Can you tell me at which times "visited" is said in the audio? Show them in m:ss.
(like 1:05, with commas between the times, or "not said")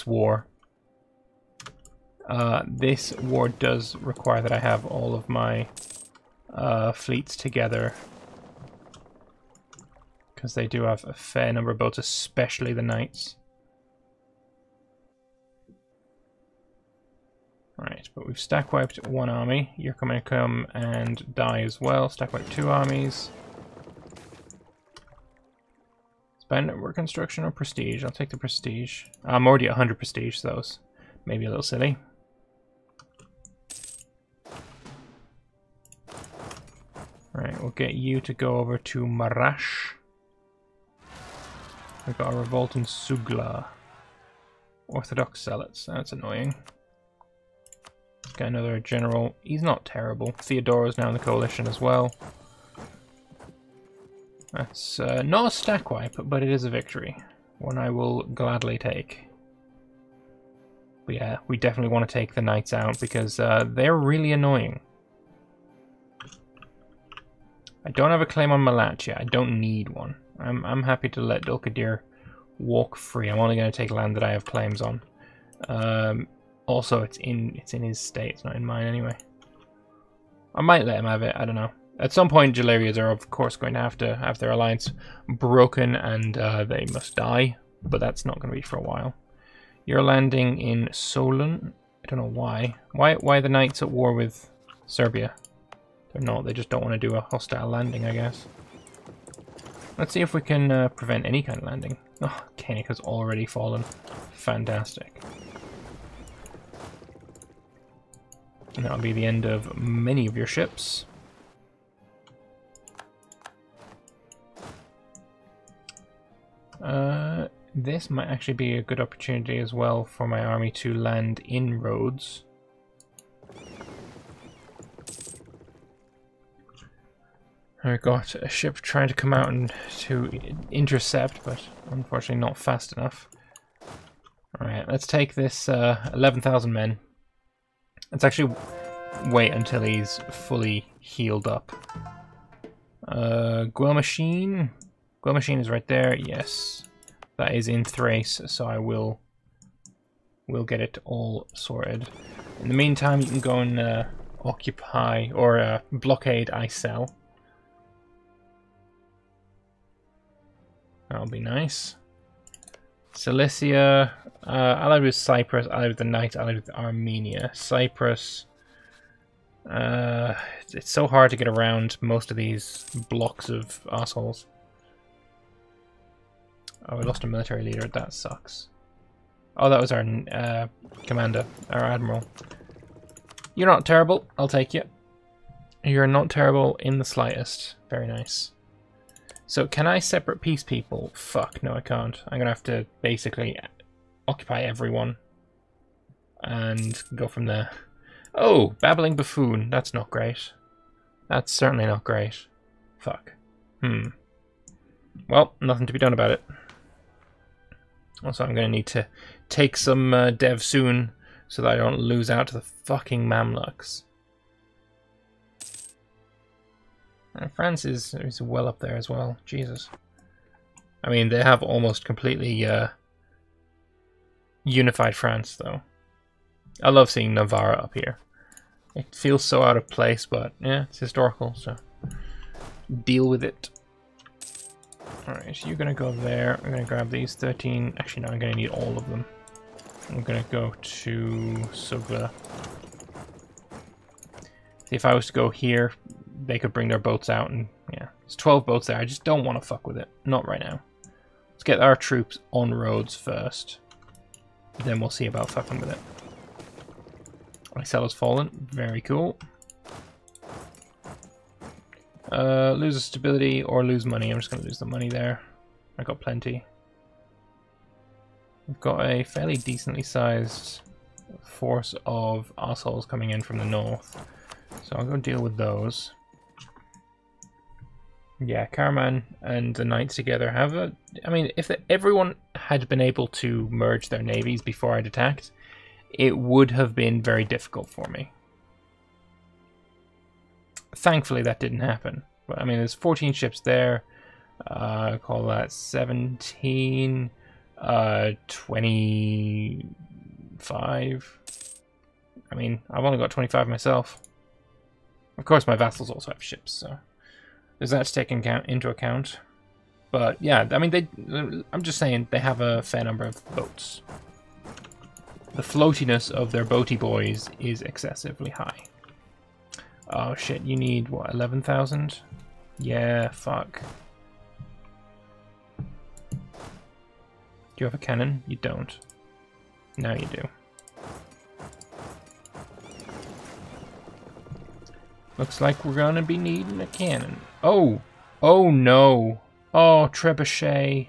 not said.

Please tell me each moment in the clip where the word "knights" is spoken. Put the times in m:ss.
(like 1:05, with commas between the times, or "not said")
0:12, 1:02, 1:33, 2:46, 4:39.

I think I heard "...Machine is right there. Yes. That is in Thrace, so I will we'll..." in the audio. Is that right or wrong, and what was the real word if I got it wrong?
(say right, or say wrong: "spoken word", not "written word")
right.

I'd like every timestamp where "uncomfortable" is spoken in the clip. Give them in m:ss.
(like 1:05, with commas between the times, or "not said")
not said.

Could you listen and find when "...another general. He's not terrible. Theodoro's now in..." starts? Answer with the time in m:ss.
0:48.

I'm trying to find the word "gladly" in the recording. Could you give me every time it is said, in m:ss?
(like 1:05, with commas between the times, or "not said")
0:58.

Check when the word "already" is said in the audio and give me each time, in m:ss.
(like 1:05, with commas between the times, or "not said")
0:29, 1:43.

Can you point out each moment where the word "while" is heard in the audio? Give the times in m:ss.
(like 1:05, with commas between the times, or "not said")
1:28.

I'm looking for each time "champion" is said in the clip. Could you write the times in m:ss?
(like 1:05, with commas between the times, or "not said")
not said.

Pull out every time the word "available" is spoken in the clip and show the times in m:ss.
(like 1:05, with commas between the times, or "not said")
not said.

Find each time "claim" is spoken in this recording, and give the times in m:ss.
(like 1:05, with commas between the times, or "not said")
1:08, 1:14.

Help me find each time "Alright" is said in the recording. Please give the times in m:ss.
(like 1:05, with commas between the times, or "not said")
2:14, 3:55.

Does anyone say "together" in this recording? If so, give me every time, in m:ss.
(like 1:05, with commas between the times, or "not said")
0:07, 4:40.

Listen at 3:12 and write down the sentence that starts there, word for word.
I'm gonna have to basically occupy everyone and go from there.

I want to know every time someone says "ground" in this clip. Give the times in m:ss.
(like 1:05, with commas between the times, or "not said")
not said.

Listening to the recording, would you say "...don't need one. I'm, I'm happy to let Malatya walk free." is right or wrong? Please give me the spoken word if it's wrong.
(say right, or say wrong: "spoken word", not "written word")
wrong: "Dulkadir", not "Malatya".